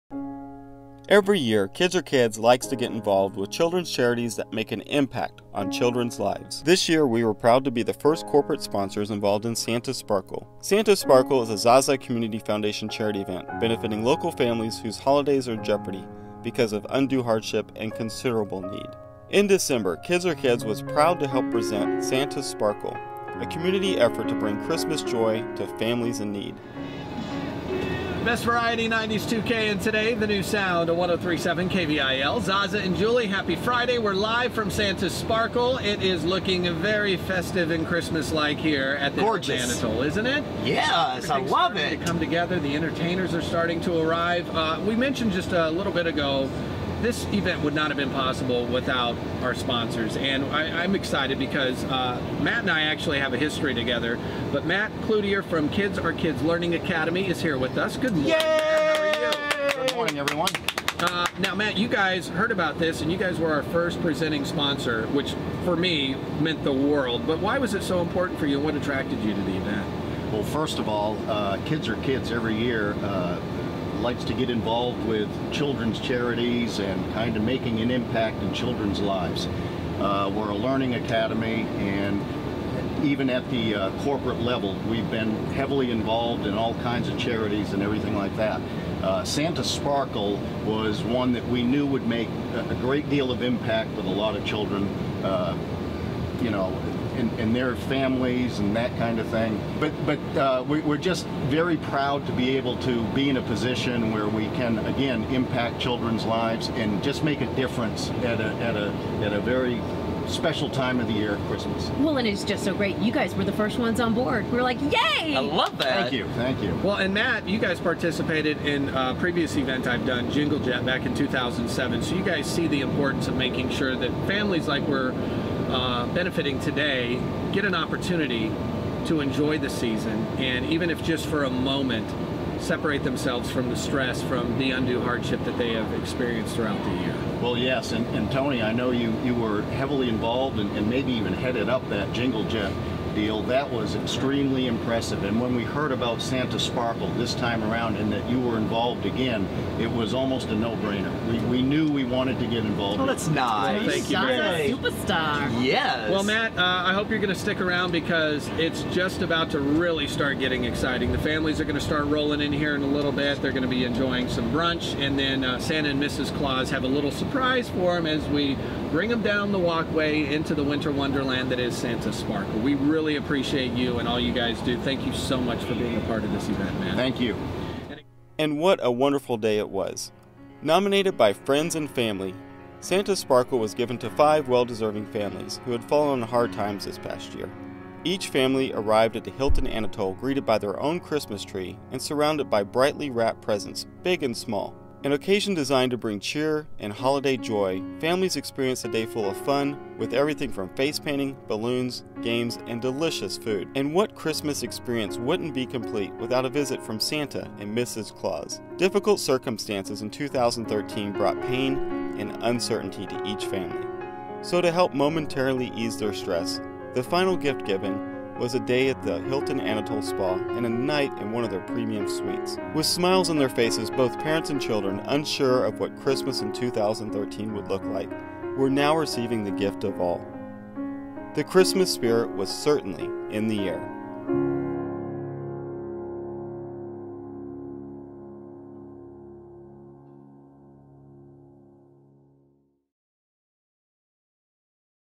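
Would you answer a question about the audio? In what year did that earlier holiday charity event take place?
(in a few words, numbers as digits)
2007.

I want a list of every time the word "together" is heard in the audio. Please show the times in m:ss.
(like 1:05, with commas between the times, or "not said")
0:42, 0:53.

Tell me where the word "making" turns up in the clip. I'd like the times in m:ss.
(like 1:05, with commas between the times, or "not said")
1:17, 2:03.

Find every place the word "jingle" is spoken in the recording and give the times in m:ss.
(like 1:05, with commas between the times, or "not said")
2:00, 2:22.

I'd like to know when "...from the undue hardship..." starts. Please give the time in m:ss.
2:14.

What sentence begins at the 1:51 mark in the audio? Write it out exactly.
Well, and it's just so great.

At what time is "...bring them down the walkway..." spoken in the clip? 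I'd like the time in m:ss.
2:48.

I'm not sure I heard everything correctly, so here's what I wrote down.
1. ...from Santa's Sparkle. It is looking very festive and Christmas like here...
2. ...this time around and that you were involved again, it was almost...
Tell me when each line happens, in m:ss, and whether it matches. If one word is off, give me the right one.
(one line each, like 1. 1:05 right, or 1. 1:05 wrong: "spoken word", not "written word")
1. 0:34 right
2. 2:27 right.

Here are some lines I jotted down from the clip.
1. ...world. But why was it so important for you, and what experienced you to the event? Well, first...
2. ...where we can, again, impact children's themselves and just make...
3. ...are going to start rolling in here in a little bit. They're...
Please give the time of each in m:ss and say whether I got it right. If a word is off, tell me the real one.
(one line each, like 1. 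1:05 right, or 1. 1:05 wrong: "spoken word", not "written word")
1. 1:06 wrong: "attracted", not "experienced"
2. 1:44 wrong: "lives", not "themselves"
3. 2:41 right.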